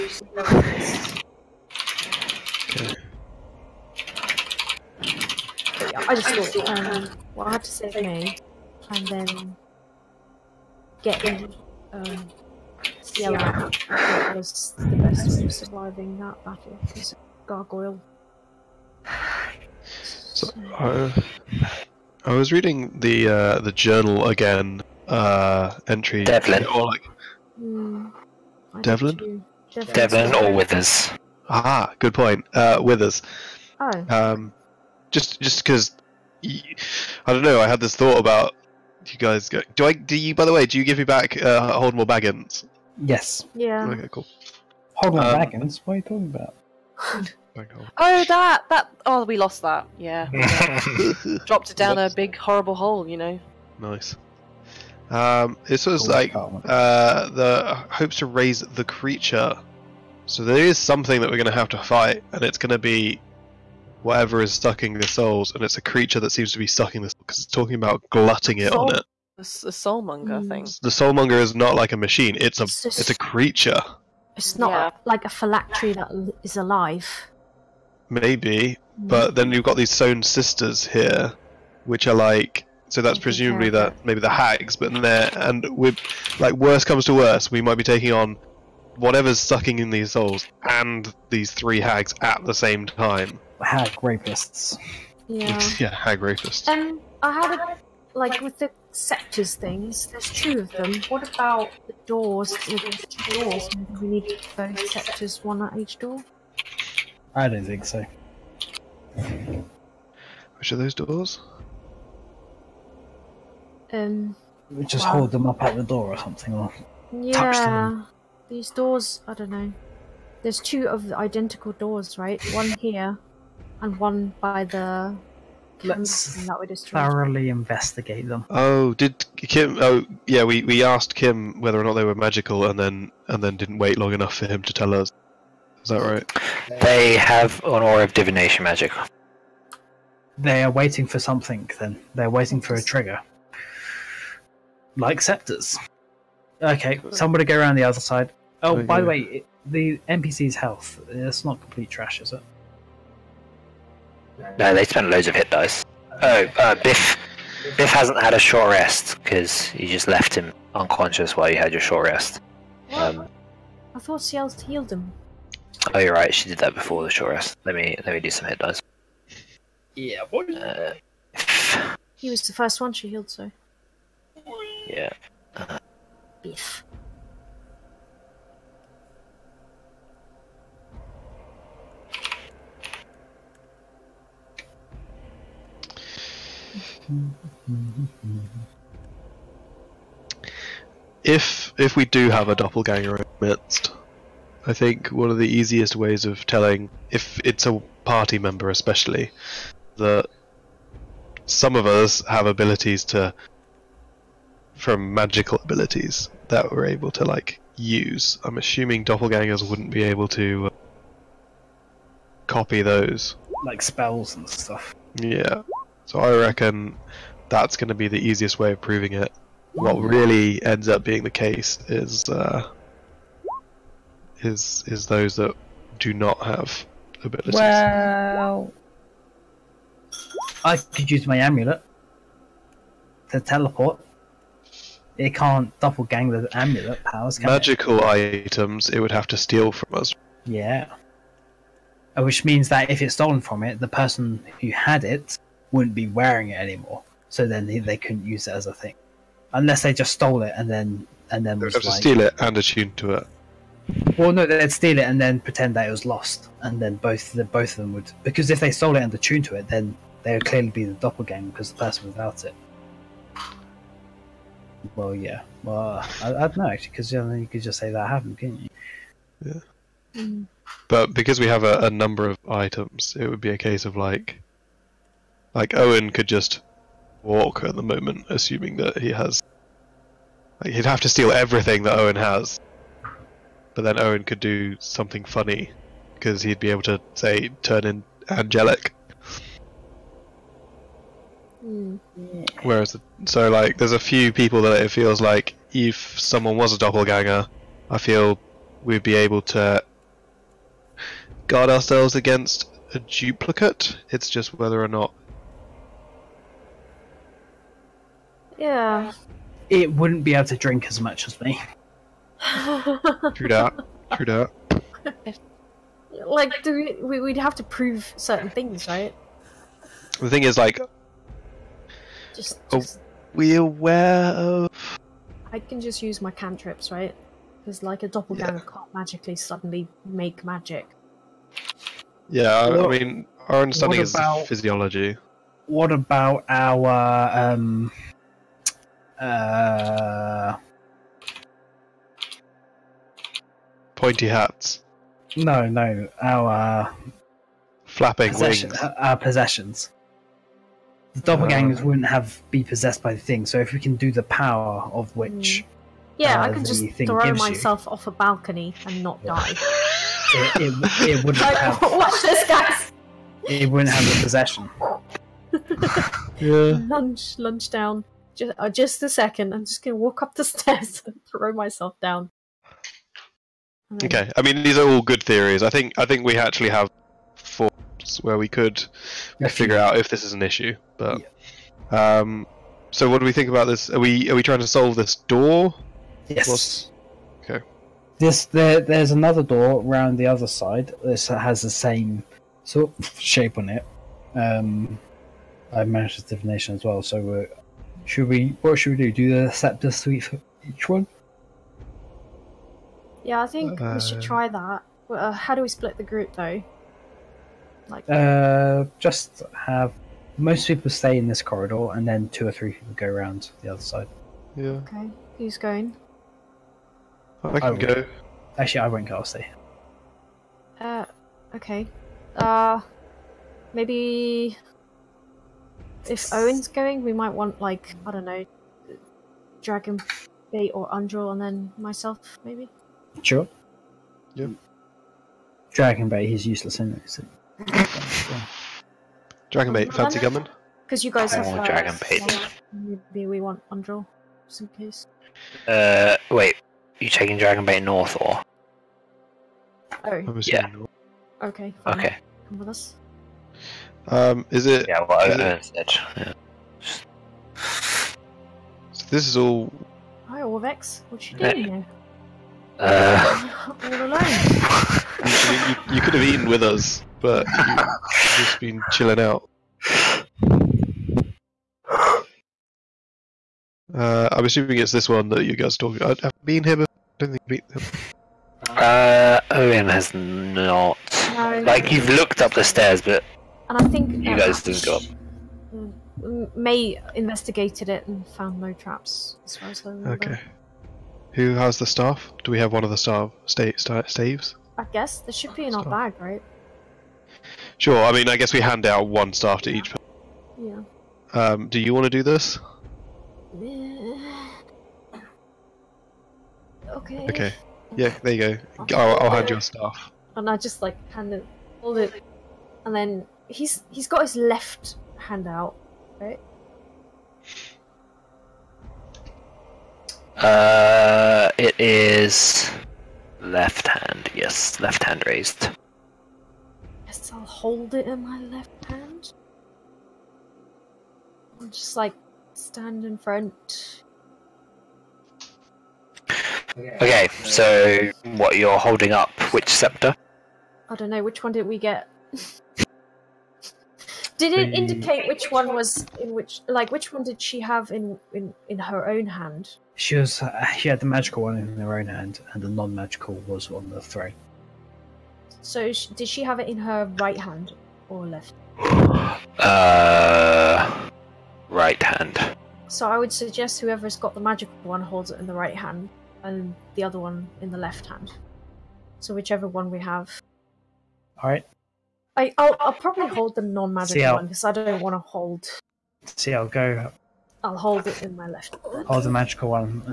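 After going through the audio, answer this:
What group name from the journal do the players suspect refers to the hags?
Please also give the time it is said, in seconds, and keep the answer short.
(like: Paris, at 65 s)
sewn sisters, at 79 s.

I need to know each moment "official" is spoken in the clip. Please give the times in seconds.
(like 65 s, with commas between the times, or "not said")
not said.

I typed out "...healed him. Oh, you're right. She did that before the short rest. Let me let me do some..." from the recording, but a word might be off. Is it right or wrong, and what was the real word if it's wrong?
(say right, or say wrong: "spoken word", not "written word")
right.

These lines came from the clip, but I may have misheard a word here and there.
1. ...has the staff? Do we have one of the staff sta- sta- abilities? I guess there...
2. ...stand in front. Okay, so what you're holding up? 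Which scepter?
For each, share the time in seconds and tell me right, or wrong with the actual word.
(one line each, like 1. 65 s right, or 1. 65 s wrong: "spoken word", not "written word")
1. 491 s wrong: "staves", not "abilities"
2. 532 s right.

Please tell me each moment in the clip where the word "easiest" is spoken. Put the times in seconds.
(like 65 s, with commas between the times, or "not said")
195 s, 218 s.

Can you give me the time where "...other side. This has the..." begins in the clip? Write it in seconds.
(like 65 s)
390 s.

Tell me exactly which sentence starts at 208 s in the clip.
I'm assuming doppelgangers wouldn't be able to uh, copy those.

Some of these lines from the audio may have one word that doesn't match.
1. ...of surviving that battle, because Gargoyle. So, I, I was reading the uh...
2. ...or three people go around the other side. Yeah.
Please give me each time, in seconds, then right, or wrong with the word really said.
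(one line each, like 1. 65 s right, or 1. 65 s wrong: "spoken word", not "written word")
1. 15 s right
2. 412 s right.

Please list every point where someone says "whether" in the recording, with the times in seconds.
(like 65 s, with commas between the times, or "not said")
131 s, 304 s.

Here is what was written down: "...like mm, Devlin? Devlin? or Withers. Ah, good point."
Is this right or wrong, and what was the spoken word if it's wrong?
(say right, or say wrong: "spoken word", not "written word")
right.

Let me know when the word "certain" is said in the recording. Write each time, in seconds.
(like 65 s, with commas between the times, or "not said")
318 s.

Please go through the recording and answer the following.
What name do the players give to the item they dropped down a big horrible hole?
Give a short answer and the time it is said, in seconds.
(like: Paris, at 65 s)
Holdmore Baggins, at 41 s.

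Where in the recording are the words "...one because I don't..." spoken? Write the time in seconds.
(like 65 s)
574 s.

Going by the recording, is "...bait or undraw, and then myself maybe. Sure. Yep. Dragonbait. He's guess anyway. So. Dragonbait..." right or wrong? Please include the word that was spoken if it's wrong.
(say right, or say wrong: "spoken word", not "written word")
wrong: "useless", not "guess".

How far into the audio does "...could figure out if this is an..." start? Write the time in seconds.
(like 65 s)
378 s.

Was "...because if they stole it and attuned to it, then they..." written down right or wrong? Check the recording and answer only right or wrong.
right.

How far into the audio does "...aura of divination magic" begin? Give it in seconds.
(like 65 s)
137 s.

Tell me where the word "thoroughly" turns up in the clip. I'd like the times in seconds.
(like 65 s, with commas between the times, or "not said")
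126 s.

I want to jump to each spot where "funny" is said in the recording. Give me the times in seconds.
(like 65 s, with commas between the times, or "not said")
285 s.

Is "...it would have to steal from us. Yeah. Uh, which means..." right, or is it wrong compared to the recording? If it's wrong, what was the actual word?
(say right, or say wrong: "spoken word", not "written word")
right.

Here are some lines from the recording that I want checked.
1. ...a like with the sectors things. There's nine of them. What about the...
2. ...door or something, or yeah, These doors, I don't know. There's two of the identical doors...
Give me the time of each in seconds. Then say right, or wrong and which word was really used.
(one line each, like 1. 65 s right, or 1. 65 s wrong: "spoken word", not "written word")
1. 97 s wrong: "two", not "nine"
2. 115 s right.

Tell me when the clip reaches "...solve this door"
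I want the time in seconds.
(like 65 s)
384 s.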